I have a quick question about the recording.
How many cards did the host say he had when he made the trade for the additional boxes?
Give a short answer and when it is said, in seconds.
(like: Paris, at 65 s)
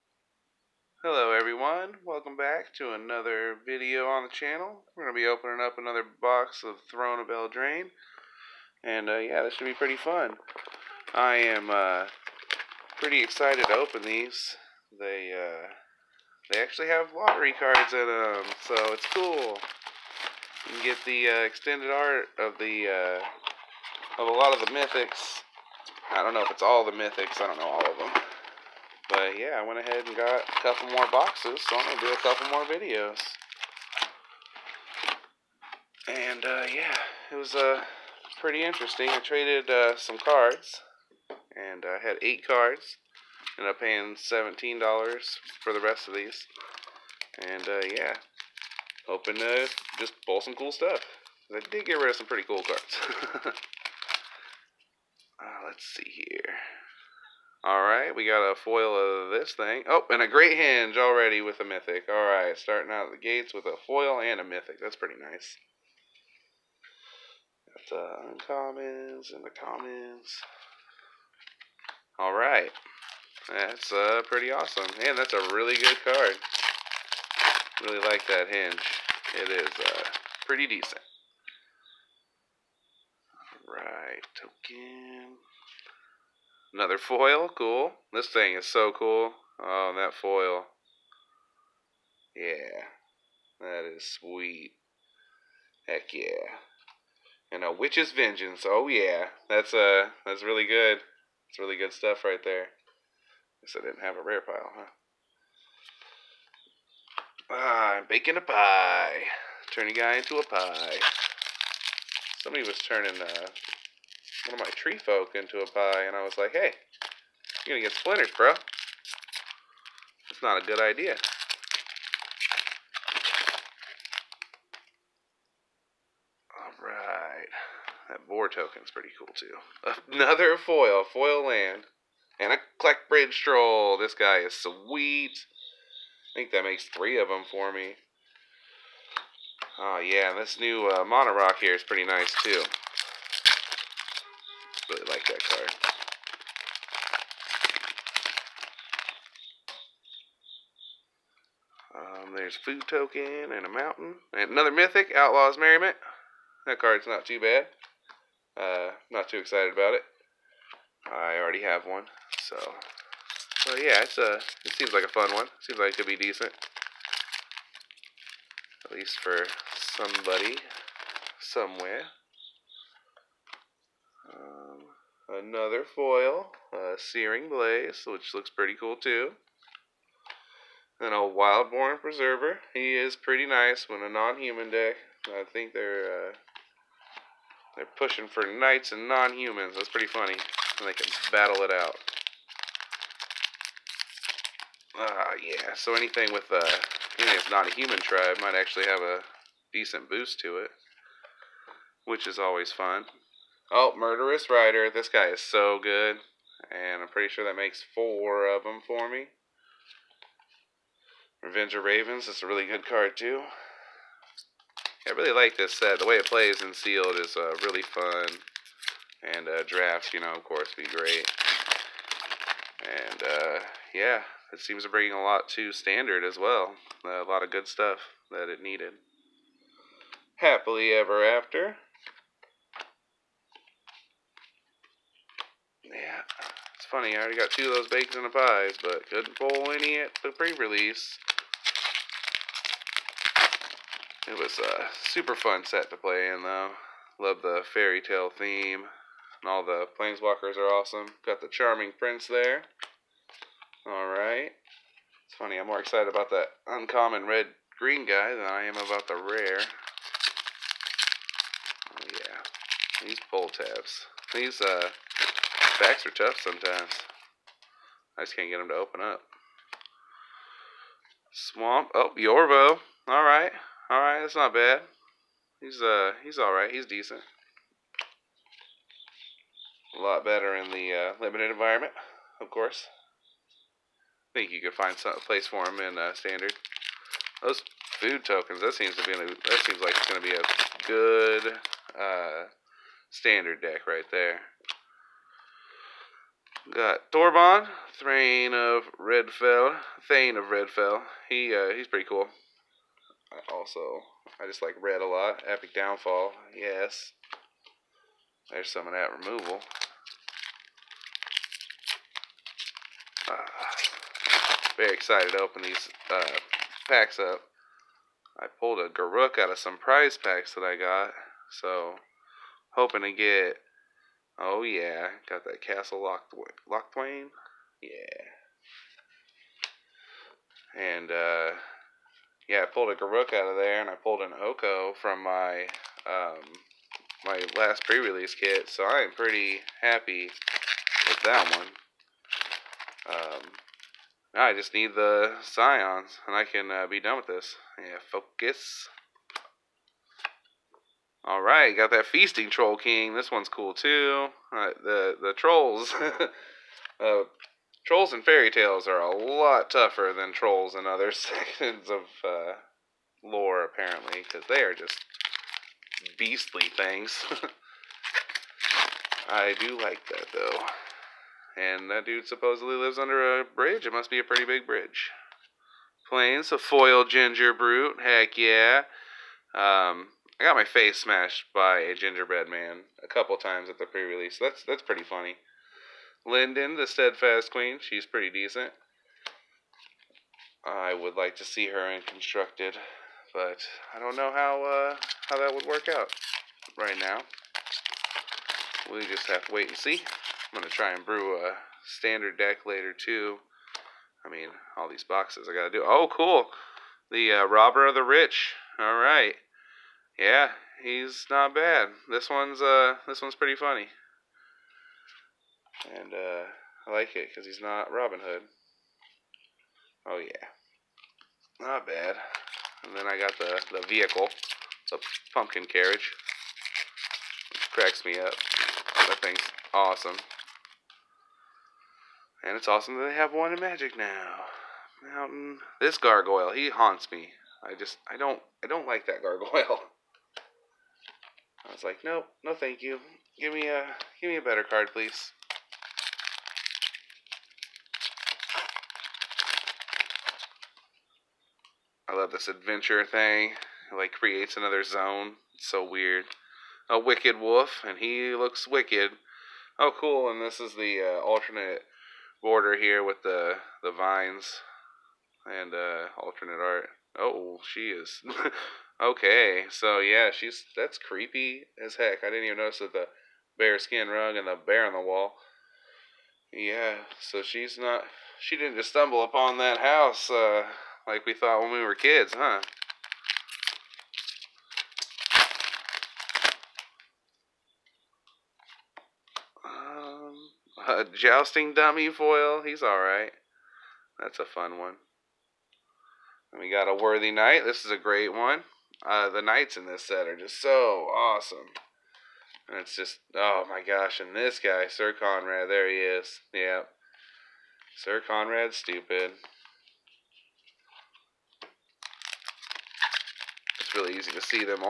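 8, at 42 s.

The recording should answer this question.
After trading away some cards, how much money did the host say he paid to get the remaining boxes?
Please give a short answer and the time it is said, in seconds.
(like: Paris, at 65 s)
$17, at 44 s.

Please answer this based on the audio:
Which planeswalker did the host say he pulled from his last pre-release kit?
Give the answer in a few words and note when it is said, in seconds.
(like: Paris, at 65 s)
Oko, at 334 s.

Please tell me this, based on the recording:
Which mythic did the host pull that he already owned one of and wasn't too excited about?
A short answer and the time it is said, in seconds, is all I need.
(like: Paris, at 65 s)
Outlaw's Merriment, at 155 s.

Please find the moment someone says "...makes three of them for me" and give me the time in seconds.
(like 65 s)
136 s.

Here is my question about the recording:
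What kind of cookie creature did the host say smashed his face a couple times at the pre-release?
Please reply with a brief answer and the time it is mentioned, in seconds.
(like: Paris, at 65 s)
Gingerbread man, at 381 s.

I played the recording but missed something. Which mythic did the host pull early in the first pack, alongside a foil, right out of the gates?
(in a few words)
Great Henge.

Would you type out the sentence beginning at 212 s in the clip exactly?
It's a really good card, too.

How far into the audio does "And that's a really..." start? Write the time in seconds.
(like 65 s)
75 s.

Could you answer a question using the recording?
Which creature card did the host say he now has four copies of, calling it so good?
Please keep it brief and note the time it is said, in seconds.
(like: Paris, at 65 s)
Murderous Rider, at 203 s.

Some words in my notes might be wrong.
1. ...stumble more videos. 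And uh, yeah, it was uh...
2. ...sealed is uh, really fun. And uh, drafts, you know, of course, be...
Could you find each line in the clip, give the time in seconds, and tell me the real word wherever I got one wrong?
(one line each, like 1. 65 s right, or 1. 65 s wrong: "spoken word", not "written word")
1. 32 s wrong: "couple", not "stumble"
2. 216 s right.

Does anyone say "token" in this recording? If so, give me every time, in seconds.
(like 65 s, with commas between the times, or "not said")
84 s, 128 s, 152 s, 288 s.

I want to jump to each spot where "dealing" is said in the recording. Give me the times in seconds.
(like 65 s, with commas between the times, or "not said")
not said.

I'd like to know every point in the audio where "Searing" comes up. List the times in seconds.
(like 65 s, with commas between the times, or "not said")
176 s.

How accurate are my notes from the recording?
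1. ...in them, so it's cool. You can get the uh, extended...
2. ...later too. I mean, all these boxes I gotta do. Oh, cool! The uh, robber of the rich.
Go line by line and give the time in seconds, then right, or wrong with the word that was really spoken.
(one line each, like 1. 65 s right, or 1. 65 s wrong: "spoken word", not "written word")
1. 17 s right
2. 402 s right.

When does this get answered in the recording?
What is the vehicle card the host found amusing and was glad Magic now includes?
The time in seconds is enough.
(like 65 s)
425 s.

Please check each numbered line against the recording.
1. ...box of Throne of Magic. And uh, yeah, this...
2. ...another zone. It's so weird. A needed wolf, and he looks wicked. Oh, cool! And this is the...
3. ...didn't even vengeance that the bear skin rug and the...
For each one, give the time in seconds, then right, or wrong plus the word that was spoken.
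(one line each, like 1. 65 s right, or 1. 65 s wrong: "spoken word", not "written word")
1. 6 s wrong: "Eldraine", not "Magic"
2. 454 s wrong: "wicked", not "needed"
3. 472 s wrong: "notice", not "vengeance".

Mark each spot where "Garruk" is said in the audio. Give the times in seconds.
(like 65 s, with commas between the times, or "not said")
318 s, 332 s.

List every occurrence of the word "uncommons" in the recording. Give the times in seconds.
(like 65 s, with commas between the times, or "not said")
68 s, 256 s.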